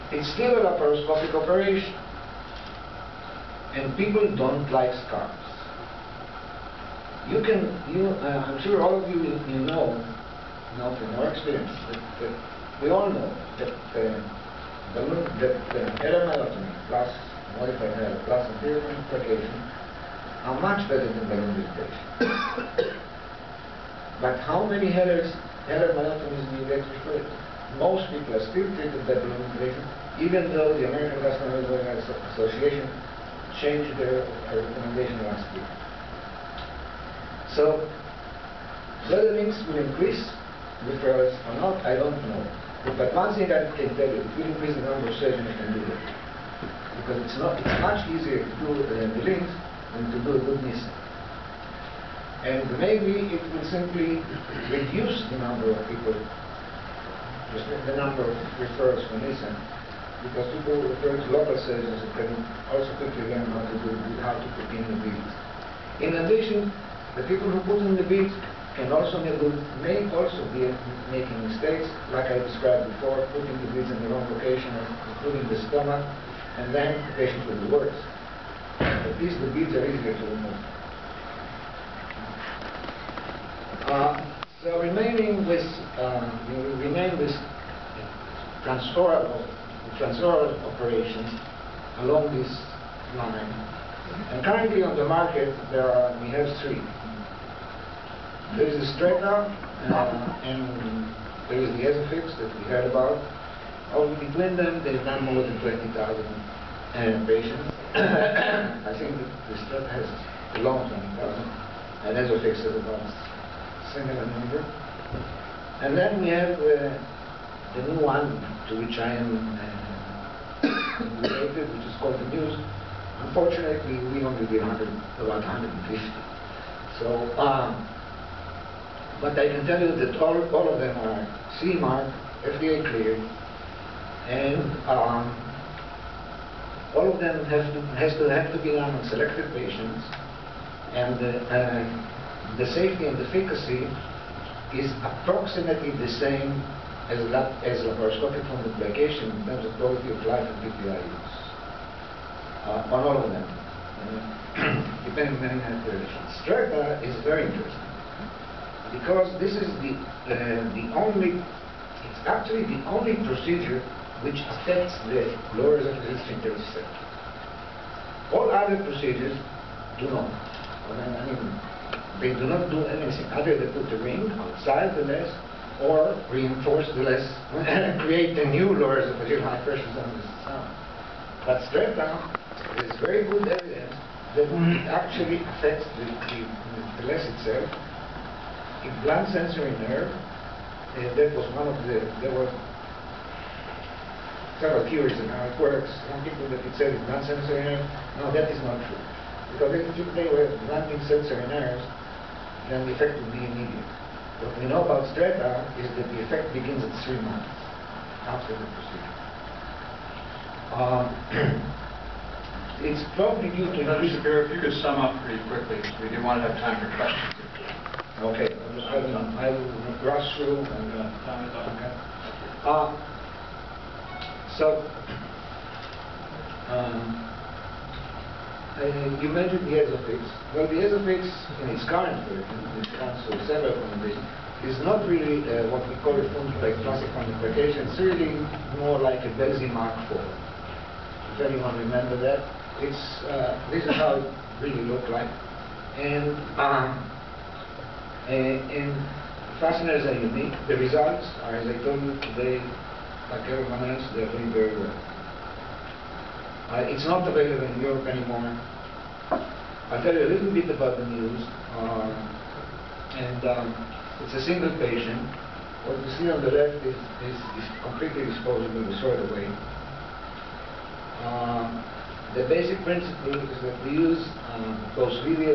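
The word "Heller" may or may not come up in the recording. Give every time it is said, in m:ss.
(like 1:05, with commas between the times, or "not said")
0:25.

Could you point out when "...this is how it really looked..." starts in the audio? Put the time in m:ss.
4:03.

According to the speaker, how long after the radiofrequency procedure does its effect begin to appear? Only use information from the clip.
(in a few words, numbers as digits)
3 months.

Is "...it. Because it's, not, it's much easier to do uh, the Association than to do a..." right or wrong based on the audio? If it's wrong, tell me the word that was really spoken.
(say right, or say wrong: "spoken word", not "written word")
wrong: "LINX", not "Association".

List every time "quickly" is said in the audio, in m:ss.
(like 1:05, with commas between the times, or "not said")
1:02, 3:35.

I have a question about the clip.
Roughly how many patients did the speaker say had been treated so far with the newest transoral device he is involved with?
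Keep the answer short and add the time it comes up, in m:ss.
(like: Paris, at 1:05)
150, at 2:05.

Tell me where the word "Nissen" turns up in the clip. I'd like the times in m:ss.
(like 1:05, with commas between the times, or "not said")
0:50, 0:59.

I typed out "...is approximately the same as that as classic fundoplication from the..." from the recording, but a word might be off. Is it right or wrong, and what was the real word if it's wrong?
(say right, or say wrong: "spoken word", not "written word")
wrong: "laparoscopic", not "classic".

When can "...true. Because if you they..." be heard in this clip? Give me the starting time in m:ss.
3:18.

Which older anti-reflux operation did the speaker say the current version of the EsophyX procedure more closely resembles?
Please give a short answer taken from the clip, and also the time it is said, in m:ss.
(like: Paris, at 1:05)
Belsey Mark IV, at 3:59.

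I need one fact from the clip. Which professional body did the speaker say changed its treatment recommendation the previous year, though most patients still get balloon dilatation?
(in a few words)
American Gastroenterological Association.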